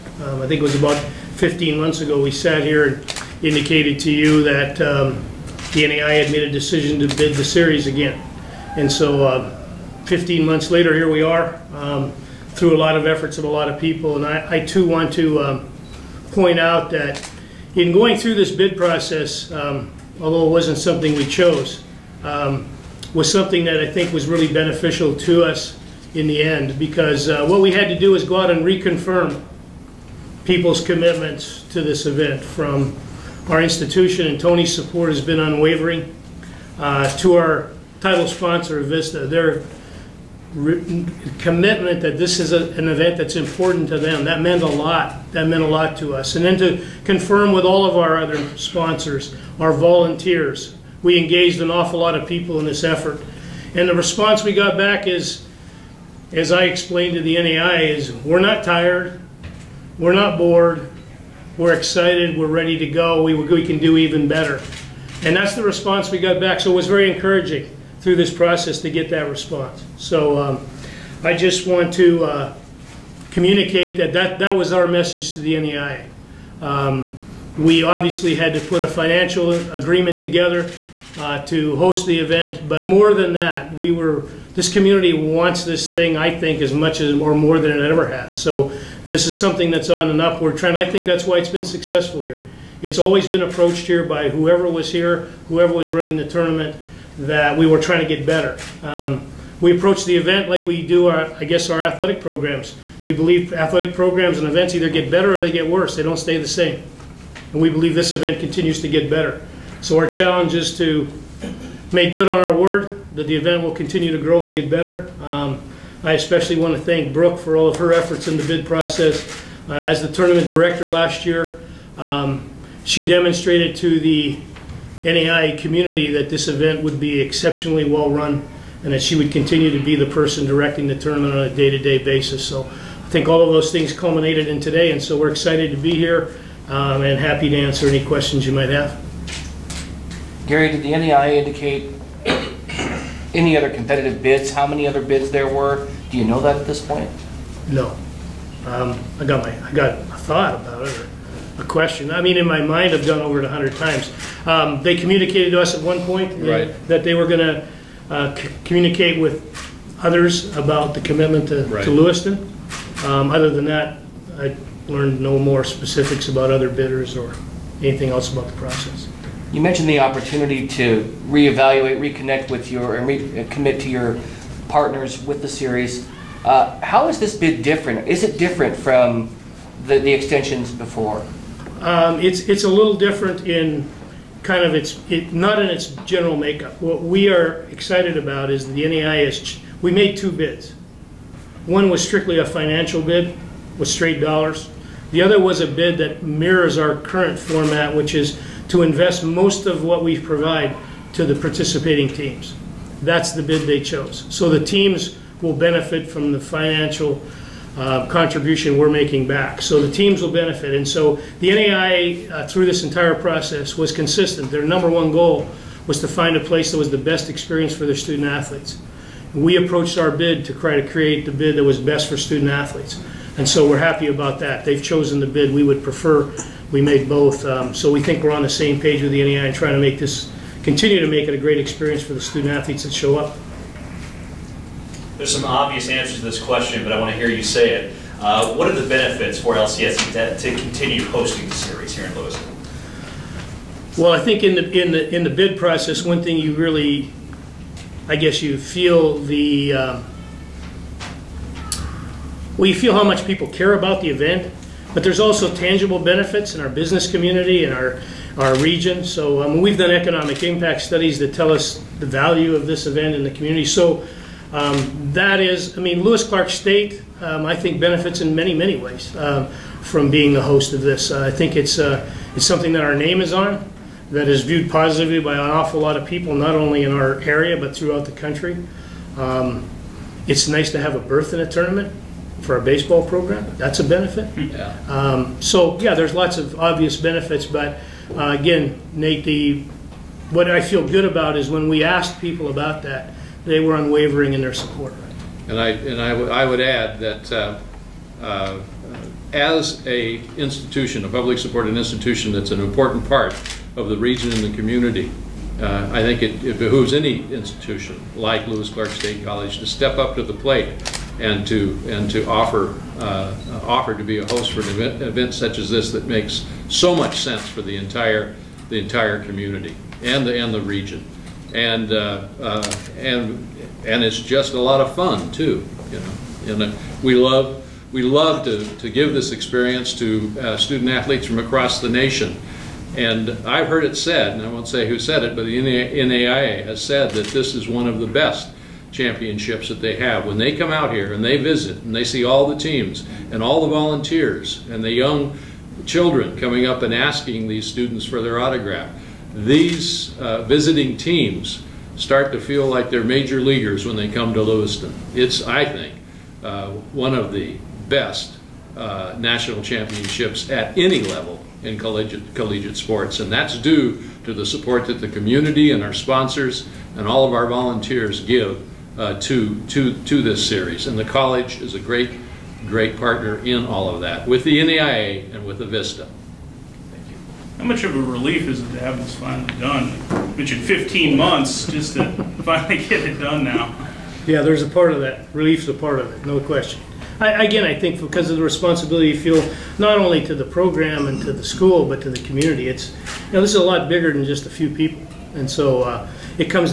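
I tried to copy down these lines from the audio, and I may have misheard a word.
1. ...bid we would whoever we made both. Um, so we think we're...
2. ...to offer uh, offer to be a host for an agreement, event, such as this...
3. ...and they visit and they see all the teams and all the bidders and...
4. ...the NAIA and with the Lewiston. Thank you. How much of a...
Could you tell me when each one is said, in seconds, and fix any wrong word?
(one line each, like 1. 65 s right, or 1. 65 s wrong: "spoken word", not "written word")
1. 225 s wrong: "prefer", not "whoever"
2. 312 s wrong: "event", not "agreement"
3. 341 s wrong: "volunteers", not "bidders"
4. 374 s wrong: "Avista", not "Lewiston".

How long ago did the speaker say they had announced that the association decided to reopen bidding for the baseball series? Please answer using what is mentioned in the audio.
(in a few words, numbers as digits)
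15 months.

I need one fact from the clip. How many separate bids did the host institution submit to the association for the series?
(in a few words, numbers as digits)
2.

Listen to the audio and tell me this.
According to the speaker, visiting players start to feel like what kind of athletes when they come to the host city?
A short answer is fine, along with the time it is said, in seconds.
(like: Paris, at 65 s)
Major leaguers, at 353 s.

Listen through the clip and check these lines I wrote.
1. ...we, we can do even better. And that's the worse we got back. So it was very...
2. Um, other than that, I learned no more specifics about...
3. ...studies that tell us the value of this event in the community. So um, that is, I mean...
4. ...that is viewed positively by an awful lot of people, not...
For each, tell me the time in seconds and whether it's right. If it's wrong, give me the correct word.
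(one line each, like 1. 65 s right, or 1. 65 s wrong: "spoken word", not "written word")
1. 63 s wrong: "response", not "worse"
2. 163 s right
3. 260 s right
4. 274 s right.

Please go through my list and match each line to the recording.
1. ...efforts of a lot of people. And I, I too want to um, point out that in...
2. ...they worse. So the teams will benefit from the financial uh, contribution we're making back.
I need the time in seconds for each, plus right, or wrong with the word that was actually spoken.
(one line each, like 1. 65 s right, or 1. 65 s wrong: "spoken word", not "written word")
1. 13 s right
2. 203 s wrong: "chose", not "worse".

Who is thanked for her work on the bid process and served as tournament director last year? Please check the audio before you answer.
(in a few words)
Brooke.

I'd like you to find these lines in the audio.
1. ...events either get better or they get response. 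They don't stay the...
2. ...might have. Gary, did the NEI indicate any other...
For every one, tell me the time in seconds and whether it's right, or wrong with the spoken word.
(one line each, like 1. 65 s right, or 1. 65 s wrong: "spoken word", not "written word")
1. 104 s wrong: "worse", not "response"
2. 138 s right.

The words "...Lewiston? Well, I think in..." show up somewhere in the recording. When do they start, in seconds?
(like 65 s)
242 s.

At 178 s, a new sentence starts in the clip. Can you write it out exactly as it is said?
Is it different from the, the extensions before?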